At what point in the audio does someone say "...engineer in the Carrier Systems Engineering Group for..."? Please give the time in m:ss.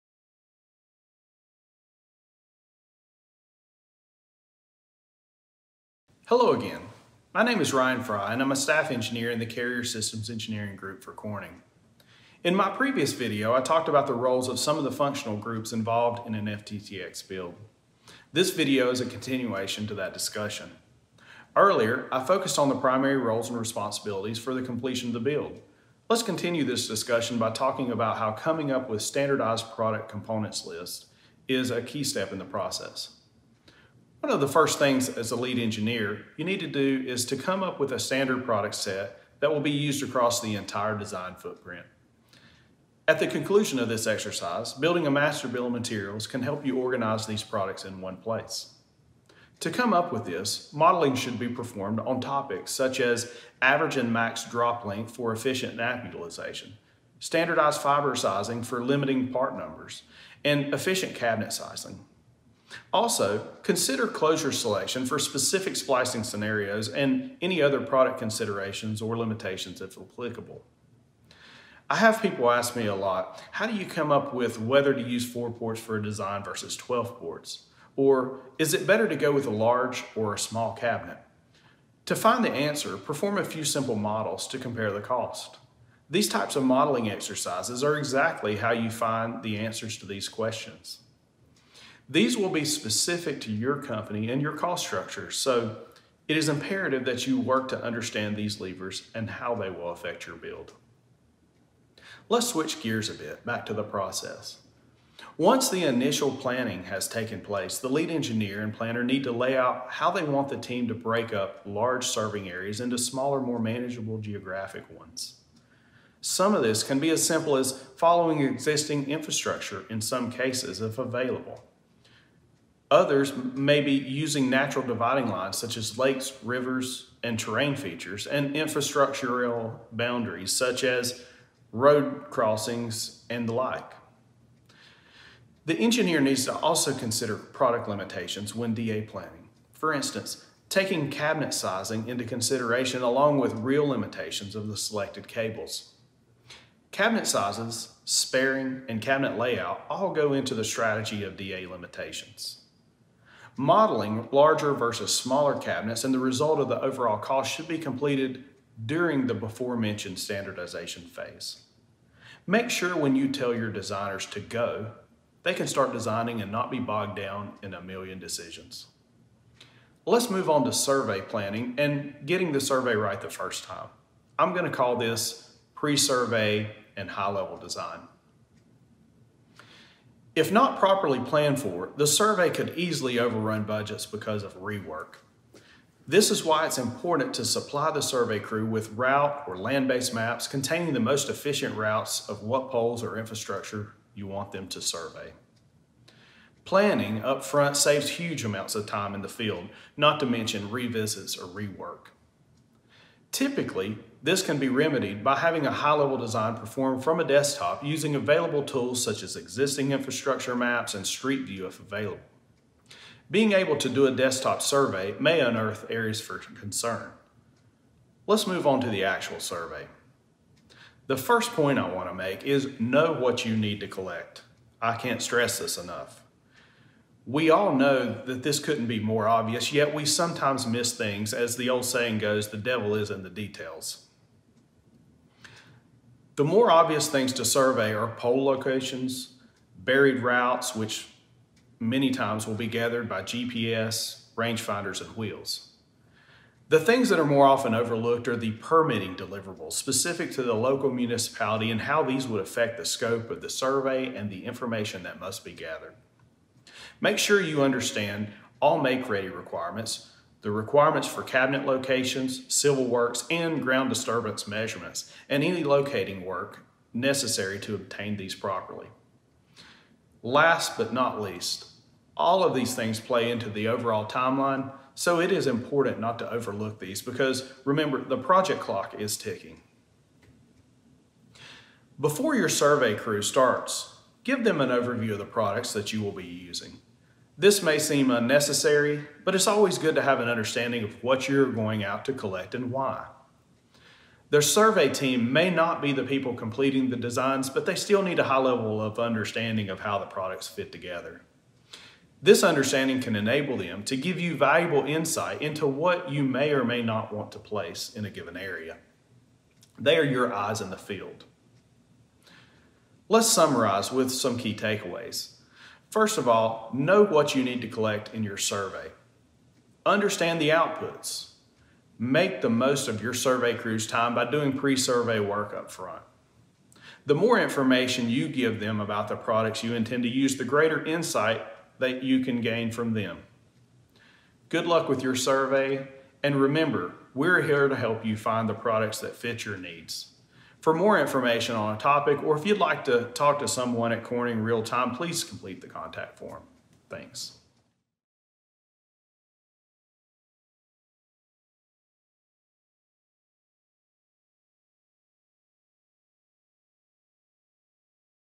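0:08.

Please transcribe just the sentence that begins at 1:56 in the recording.
Some of this can be as simple as following existing infrastructure in some cases if available.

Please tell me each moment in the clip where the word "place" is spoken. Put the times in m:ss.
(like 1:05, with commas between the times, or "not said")
0:48, 1:47, 5:07.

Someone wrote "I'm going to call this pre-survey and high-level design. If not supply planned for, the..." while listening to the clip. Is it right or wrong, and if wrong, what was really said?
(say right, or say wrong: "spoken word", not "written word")
wrong: "properly", not "supply".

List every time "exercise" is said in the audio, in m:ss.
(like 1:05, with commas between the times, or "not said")
0:44, 1:27.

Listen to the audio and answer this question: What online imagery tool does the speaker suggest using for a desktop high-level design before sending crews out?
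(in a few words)
Street View.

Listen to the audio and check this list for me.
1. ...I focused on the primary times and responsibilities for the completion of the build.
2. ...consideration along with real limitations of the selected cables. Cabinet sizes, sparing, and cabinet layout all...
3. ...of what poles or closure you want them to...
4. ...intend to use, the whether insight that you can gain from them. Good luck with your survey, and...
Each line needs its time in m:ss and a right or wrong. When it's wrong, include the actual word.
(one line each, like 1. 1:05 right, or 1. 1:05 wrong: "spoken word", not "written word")
1. 0:22 wrong: "roles", not "times"
2. 2:22 right
3. 3:12 wrong: "infrastructure", not "closure"
4. 5:29 wrong: "greater", not "whether".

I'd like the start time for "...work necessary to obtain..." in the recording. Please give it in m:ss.
4:26.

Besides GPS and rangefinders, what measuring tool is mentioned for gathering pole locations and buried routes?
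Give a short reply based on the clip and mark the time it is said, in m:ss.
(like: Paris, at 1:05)
Wheels, at 4:05.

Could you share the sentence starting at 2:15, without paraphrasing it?
The engineer needs to also consider product limitations when DA planning.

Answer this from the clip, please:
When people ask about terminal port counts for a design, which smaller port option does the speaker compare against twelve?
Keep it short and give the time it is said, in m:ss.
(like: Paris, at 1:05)
4 ports, at 1:15.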